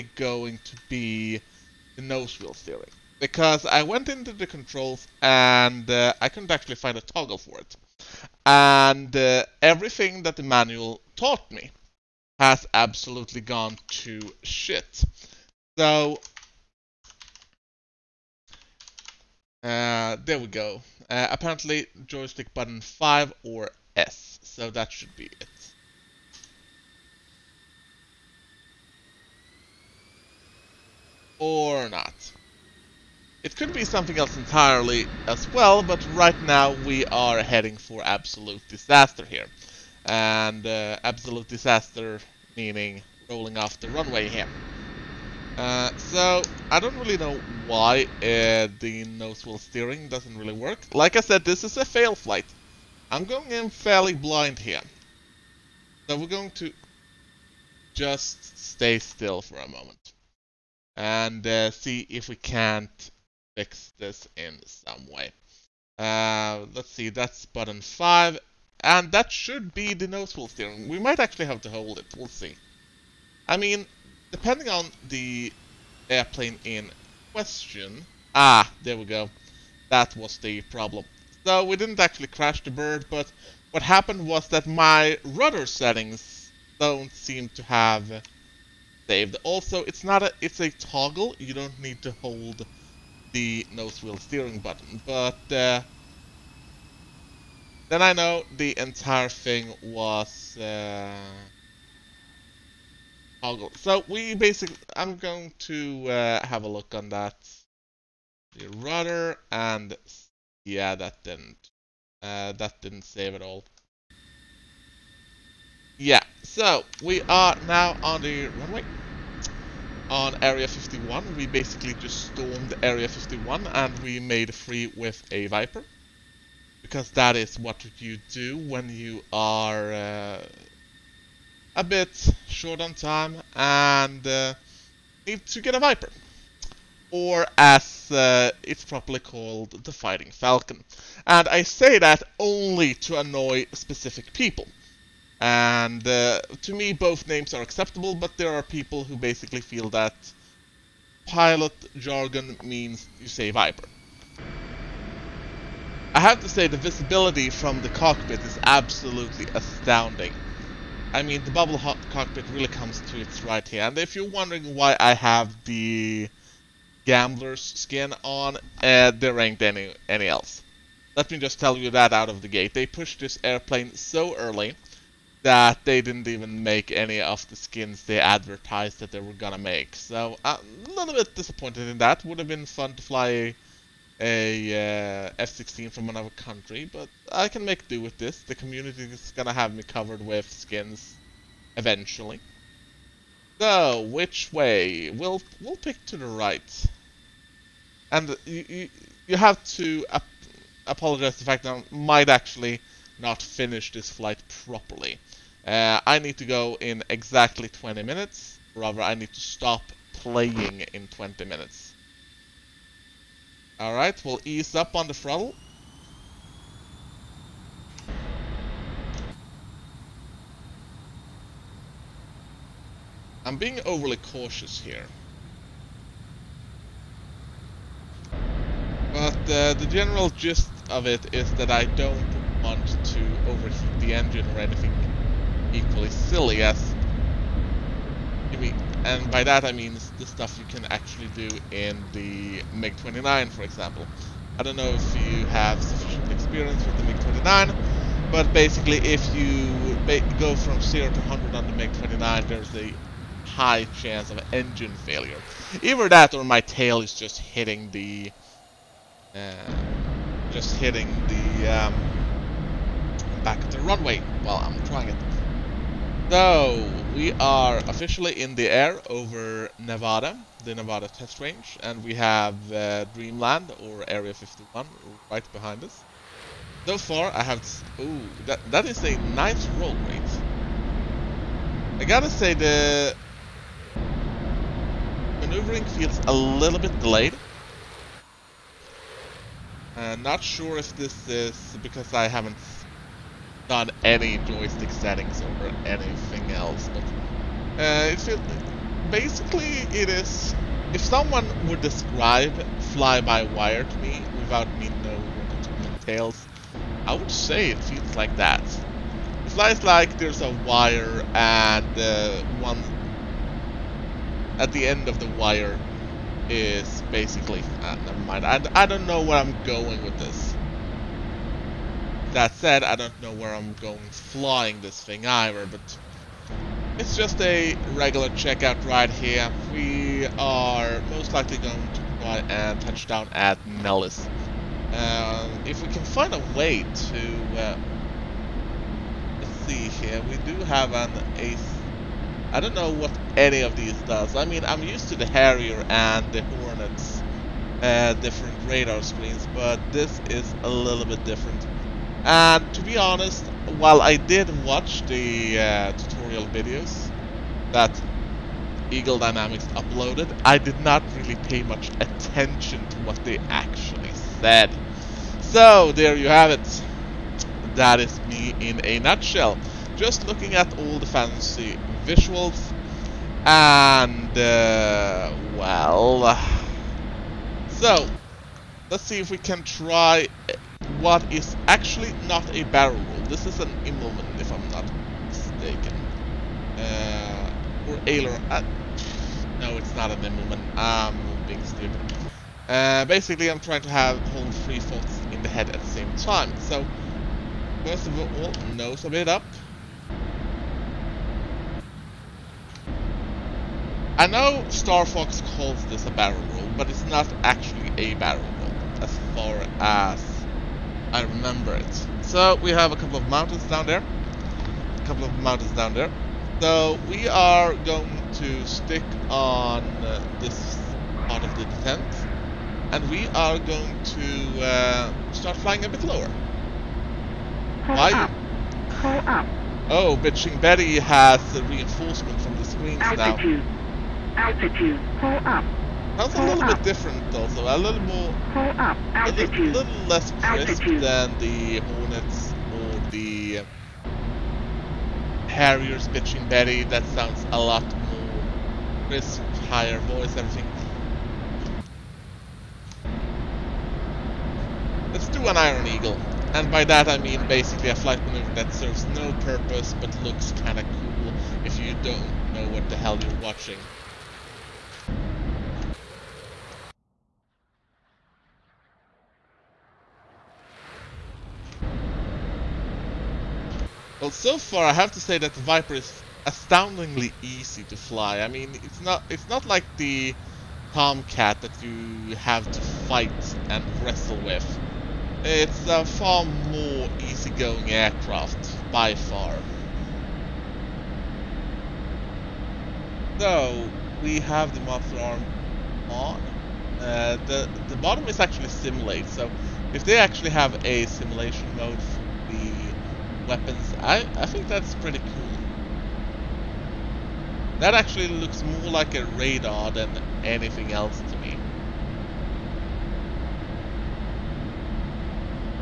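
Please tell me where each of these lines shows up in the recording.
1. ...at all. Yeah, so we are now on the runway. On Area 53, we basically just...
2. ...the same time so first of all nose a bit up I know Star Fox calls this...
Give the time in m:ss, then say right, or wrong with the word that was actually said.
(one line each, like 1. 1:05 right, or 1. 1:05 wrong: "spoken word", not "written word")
1. 1:53 wrong: "51", not "53"
2. 6:35 right.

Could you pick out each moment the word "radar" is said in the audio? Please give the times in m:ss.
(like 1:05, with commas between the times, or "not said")
5:48, 8:29.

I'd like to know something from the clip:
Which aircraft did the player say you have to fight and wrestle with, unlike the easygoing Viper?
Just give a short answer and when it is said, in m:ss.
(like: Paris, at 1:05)
Tomcat, at 8:00.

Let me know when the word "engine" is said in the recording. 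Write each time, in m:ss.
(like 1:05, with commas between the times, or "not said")
3:54, 4:14.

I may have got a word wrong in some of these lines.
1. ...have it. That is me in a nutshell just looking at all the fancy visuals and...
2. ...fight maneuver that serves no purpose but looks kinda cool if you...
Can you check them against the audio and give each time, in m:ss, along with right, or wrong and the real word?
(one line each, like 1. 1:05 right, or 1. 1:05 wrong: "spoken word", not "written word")
1. 6:06 right
2. 7:37 wrong: "flight", not "fight".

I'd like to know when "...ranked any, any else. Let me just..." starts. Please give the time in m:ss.
2:49.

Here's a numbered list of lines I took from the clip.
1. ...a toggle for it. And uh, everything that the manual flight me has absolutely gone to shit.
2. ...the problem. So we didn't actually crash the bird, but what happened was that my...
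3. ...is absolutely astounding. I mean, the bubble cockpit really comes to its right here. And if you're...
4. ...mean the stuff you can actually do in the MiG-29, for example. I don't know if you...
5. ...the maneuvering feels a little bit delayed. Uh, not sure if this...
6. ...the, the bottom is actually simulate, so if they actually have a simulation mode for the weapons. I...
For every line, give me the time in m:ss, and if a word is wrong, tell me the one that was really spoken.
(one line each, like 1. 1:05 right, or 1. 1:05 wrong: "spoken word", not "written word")
1. 0:06 wrong: "taught", not "flight"
2. 1:20 right
3. 2:38 right
4. 3:59 right
5. 4:42 right
6. 8:17 right.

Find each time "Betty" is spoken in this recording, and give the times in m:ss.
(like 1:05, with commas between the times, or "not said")
7:10, 7:26.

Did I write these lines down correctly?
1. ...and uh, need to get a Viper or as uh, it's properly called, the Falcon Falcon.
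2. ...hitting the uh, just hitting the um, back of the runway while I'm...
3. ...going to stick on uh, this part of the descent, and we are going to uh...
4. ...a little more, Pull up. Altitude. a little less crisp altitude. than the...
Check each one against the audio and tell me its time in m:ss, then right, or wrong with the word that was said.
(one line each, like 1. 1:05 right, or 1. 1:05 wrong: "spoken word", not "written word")
1. 2:13 wrong: "Fighting", not "Falcon"
2. 4:17 right
3. 6:57 right
4. 7:17 right.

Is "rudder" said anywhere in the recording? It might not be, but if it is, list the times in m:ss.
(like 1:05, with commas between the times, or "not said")
1:25, 1:48.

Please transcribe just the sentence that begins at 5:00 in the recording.
If someone would describe fly-by-wire to me without me knowing the details, I would say it feels like that.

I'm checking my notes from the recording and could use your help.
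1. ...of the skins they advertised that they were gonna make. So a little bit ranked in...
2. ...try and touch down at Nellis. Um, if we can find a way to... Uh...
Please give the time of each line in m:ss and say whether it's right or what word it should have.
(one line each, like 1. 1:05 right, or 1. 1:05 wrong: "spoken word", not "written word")
1. 2:57 wrong: "disappointed", not "ranked"
2. 5:32 right.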